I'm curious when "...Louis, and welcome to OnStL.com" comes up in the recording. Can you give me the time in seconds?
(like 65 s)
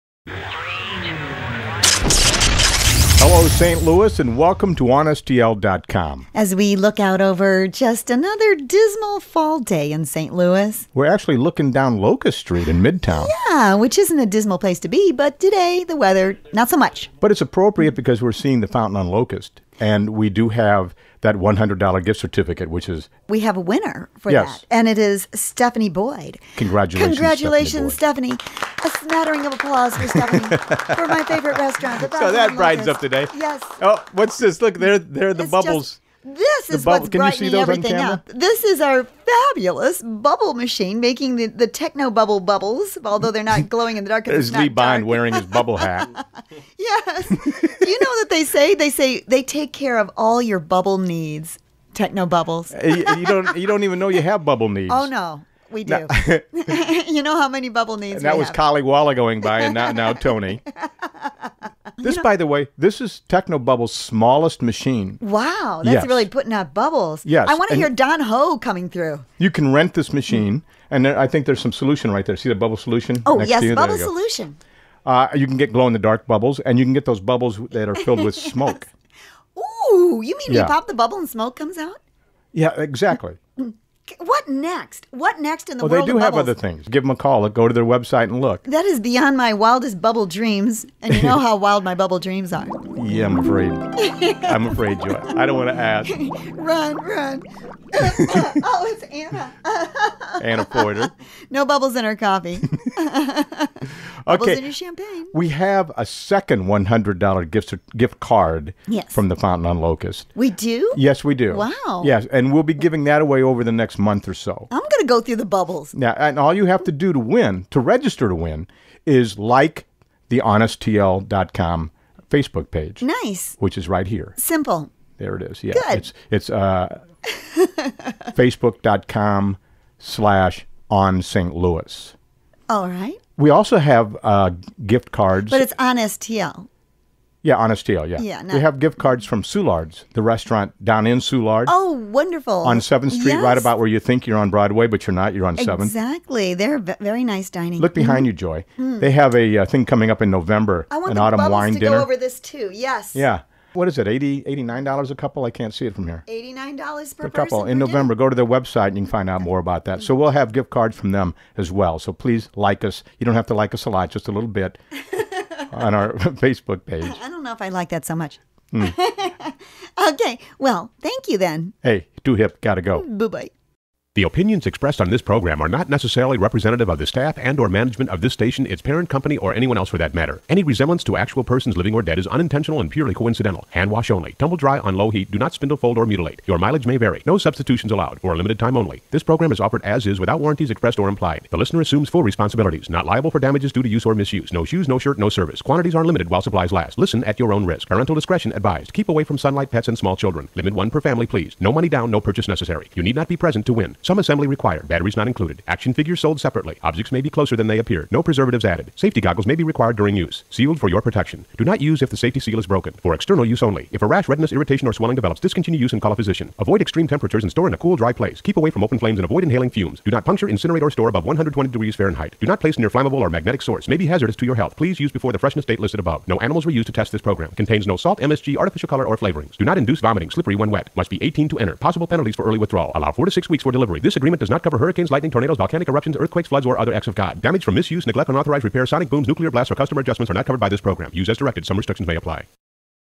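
3 s.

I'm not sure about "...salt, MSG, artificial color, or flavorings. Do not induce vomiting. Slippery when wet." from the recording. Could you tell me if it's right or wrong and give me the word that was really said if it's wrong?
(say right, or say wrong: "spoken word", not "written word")
right.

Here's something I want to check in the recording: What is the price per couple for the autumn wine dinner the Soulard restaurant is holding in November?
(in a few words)
$89.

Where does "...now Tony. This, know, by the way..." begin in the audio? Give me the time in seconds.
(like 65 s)
59 s.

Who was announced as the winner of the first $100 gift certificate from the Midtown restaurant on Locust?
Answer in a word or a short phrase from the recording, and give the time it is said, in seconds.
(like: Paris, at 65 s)
Stephanie Boyd, at 25 s.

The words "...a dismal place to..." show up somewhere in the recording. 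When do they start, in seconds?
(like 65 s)
14 s.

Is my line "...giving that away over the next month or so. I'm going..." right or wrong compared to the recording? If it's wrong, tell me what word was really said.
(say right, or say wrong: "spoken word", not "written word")
right.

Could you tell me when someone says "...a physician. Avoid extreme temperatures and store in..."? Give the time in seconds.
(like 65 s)
216 s.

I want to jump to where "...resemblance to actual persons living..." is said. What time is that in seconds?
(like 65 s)
180 s.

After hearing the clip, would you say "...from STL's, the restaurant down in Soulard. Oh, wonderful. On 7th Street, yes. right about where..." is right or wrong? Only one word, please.
wrong.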